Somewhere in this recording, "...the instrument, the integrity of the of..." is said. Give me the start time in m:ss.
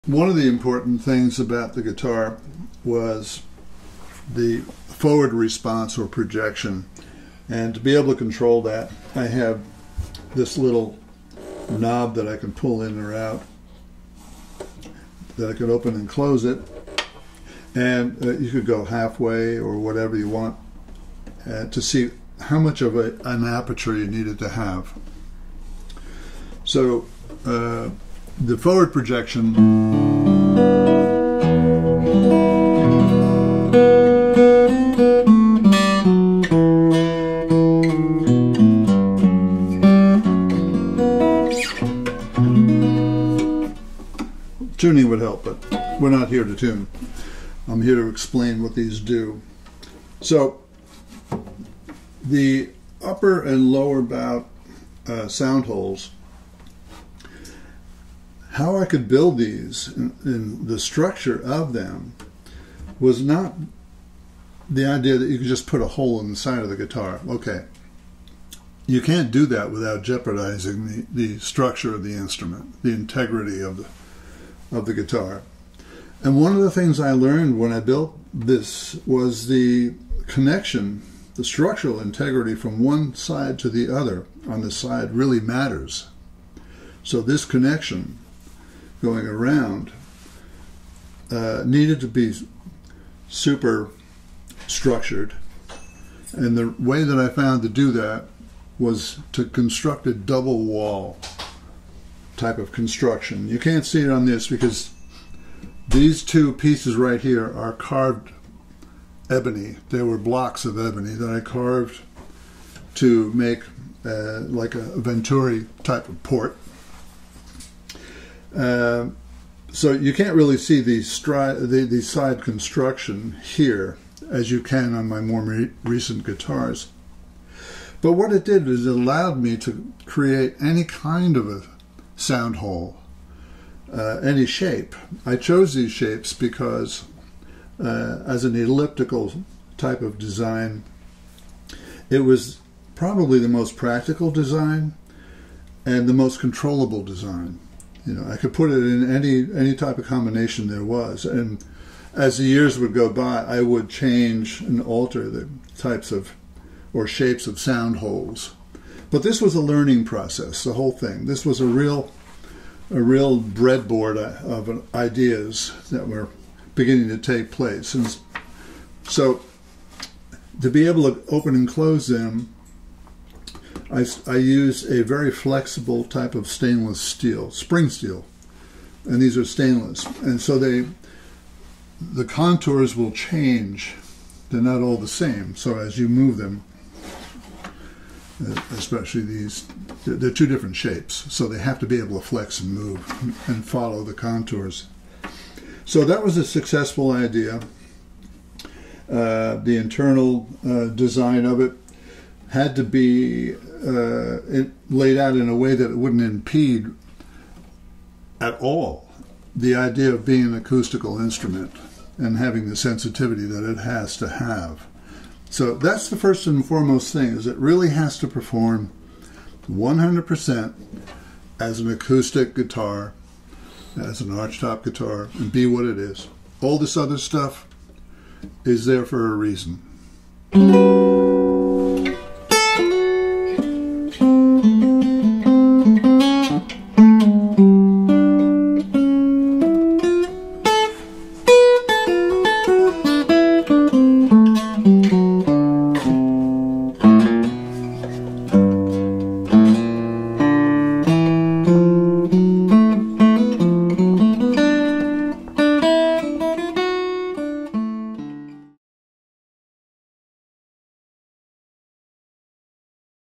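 1:12.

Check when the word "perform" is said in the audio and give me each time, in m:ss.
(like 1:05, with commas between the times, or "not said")
3:38.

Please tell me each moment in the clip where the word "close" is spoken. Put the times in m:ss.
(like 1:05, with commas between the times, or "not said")
0:16, 2:51.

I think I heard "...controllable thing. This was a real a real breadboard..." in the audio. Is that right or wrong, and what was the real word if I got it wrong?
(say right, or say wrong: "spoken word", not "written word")
wrong: "whole", not "controllable".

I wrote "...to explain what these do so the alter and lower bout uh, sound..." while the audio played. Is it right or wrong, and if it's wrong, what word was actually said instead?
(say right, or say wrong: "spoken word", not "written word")
wrong: "upper", not "alter".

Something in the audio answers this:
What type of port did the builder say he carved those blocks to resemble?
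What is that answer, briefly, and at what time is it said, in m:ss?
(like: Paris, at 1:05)
Venturi, at 1:54.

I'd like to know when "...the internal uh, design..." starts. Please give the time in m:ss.
3:19.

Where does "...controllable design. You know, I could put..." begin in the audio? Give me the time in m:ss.
2:26.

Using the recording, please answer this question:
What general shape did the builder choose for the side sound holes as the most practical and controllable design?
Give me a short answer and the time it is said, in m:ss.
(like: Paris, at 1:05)
Elliptical, at 2:18.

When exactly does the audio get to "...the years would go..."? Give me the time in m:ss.
2:32.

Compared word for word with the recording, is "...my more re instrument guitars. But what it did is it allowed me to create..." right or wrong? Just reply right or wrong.
wrong.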